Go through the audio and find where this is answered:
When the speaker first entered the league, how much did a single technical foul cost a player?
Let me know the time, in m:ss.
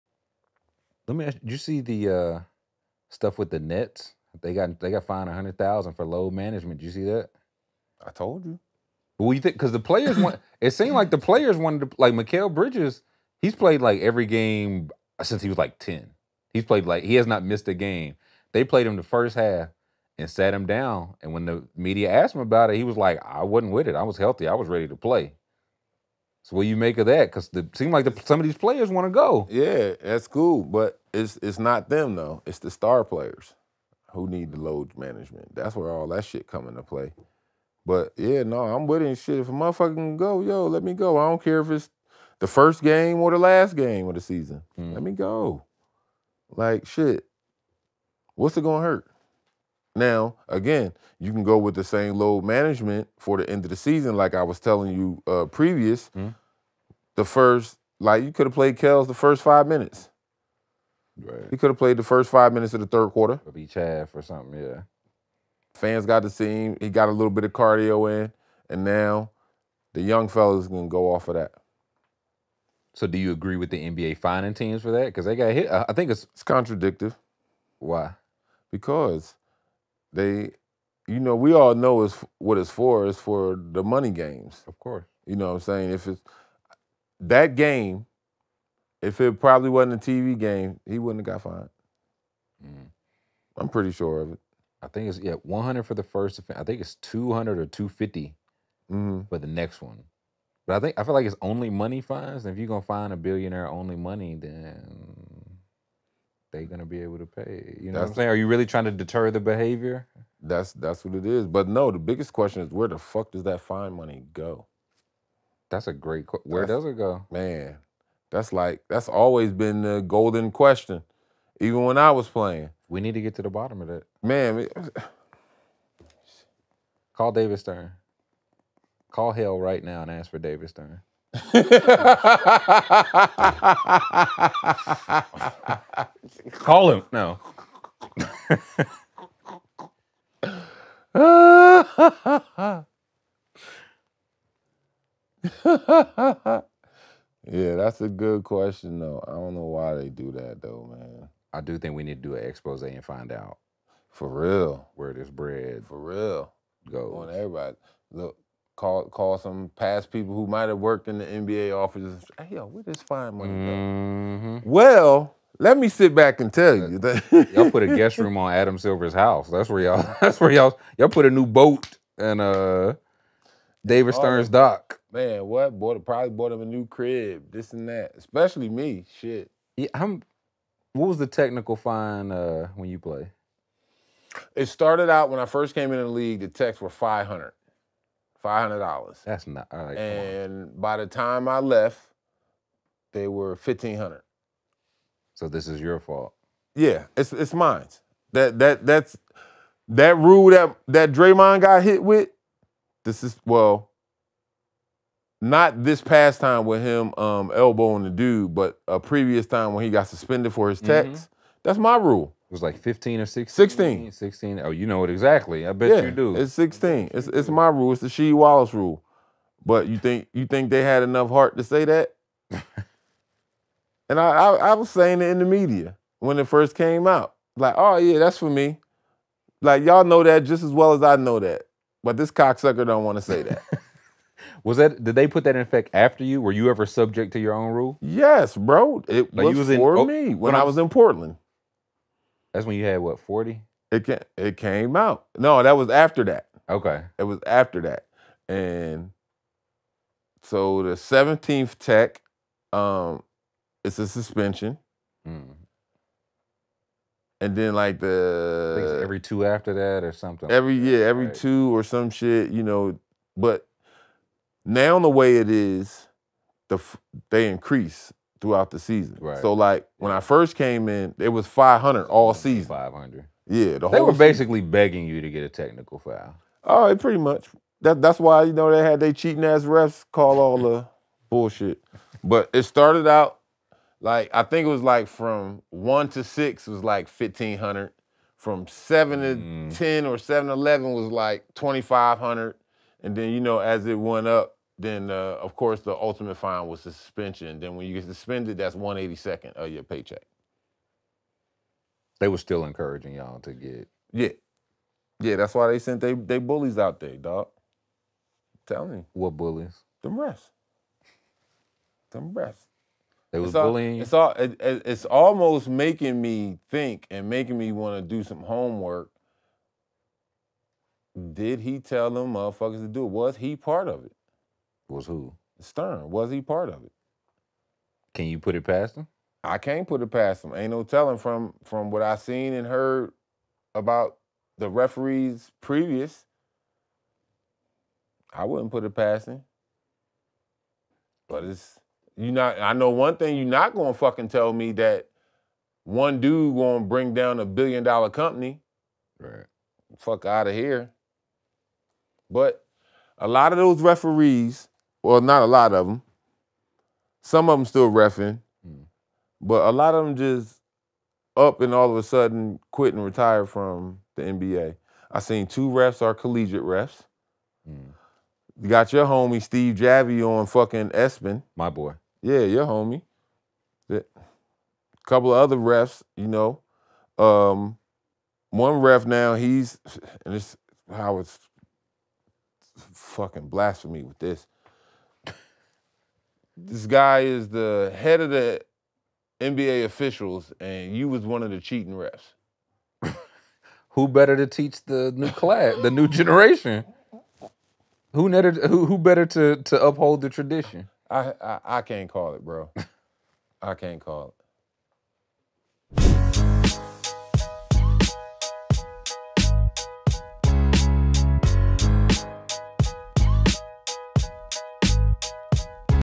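3:06.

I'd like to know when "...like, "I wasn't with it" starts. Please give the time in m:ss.
0:22.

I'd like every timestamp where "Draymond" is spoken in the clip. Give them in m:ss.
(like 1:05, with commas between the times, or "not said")
3:21.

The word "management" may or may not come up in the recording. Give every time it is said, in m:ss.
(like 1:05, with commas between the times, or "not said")
0:06, 0:34, 0:52.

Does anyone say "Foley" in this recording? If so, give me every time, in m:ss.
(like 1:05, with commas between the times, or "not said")
not said.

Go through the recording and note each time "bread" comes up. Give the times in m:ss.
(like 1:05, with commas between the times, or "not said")
2:35.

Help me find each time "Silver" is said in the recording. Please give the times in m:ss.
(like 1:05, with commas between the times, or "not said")
2:48.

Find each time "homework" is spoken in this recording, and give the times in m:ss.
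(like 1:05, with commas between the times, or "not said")
5:18.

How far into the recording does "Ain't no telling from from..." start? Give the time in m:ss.
5:30.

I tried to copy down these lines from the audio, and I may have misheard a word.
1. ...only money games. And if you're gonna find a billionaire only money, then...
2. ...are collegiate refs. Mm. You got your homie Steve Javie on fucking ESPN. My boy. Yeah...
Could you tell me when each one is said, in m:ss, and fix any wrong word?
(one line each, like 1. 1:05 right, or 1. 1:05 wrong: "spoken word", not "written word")
1. 1:41 wrong: "fines", not "games"
2. 6:06 right.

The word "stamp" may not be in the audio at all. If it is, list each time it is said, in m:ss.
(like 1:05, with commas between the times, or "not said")
not said.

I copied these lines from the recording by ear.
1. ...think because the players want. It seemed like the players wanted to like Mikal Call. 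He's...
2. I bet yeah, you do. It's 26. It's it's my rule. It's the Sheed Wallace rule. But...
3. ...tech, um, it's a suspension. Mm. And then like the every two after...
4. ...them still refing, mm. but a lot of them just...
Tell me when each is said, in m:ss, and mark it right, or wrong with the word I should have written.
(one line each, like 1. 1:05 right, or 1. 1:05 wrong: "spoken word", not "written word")
1. 0:09 wrong: "Bridges", not "Call"
2. 3:35 wrong: "16", not "26"
3. 4:11 right
4. 5:57 right.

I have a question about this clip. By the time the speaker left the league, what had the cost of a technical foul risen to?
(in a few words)
$1,500.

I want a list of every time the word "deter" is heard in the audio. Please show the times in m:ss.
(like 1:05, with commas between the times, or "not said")
1:48.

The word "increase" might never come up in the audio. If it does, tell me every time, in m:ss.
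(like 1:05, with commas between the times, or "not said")
4:27.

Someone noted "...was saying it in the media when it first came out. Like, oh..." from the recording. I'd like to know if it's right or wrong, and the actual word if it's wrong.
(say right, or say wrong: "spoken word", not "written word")
right.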